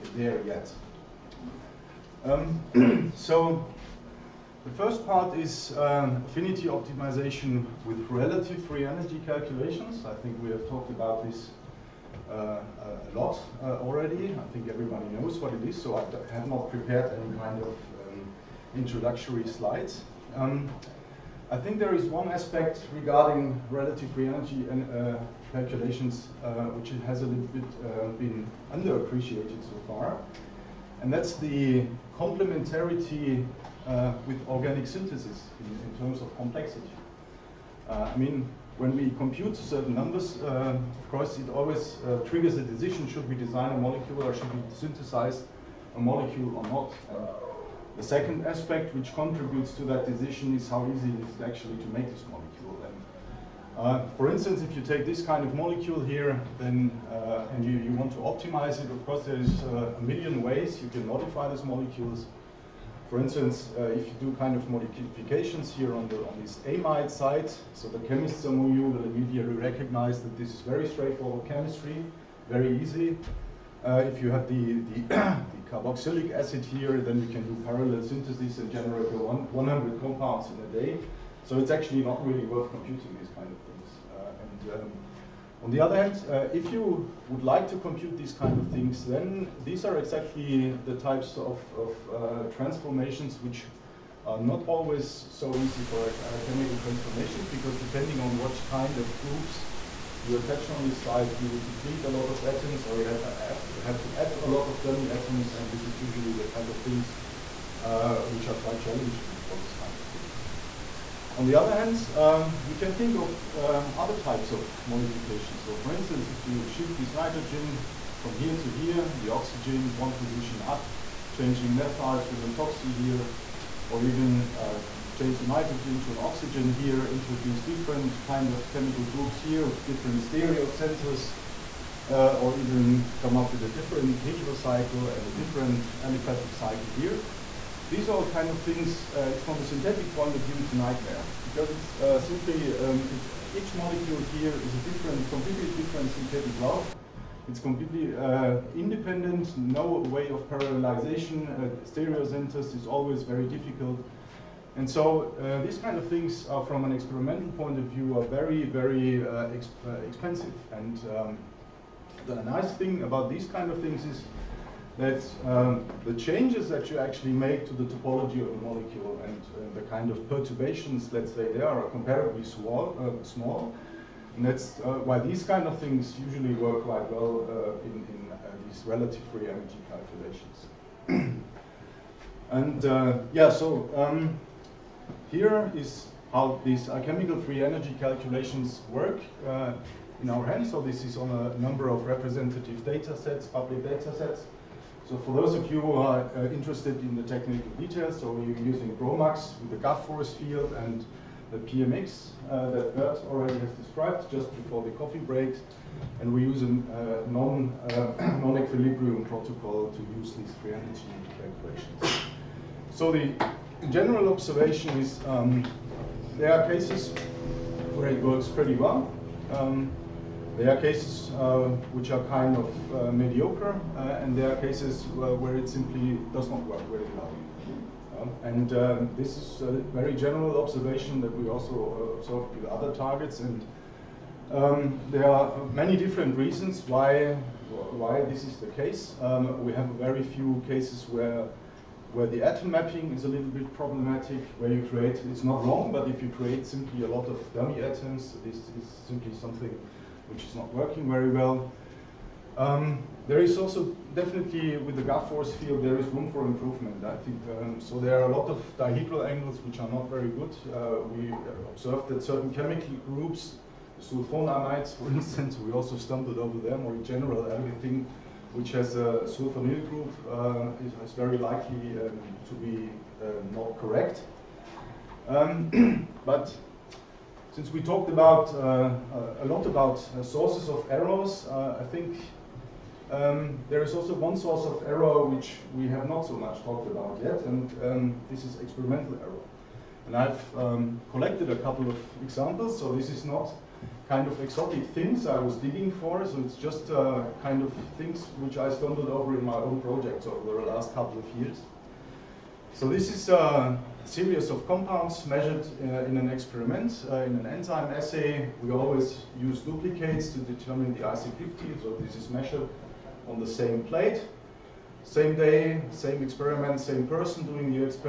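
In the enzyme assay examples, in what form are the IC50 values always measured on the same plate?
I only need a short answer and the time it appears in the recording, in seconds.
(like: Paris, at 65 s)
Duplicates, at 309 s.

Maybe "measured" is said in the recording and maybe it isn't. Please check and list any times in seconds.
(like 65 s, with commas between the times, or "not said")
305 s, 312 s.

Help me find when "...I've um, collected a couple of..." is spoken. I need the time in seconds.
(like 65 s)
290 s.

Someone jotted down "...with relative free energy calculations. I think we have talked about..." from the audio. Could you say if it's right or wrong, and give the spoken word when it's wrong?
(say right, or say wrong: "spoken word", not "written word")
right.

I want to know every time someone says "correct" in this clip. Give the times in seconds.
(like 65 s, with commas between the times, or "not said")
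273 s.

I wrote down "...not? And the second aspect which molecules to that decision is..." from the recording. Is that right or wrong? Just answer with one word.
wrong.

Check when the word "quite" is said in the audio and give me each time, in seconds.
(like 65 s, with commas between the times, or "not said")
108 s, 176 s.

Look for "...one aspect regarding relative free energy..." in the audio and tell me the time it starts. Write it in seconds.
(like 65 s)
22 s.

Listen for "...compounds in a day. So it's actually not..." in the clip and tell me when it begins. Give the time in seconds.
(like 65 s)
80 s.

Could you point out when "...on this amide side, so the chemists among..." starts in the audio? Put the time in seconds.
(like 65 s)
66 s.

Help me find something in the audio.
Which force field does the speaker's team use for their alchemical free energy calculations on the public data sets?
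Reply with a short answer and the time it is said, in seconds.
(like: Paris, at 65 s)
GAFF, at 199 s.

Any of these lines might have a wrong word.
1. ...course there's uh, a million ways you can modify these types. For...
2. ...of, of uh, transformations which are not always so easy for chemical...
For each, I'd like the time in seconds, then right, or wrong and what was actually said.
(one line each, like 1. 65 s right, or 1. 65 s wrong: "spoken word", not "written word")
1. 59 s wrong: "molecules", not "types"
2. 91 s right.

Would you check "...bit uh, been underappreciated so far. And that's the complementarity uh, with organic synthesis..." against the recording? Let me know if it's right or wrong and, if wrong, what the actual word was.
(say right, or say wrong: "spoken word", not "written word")
right.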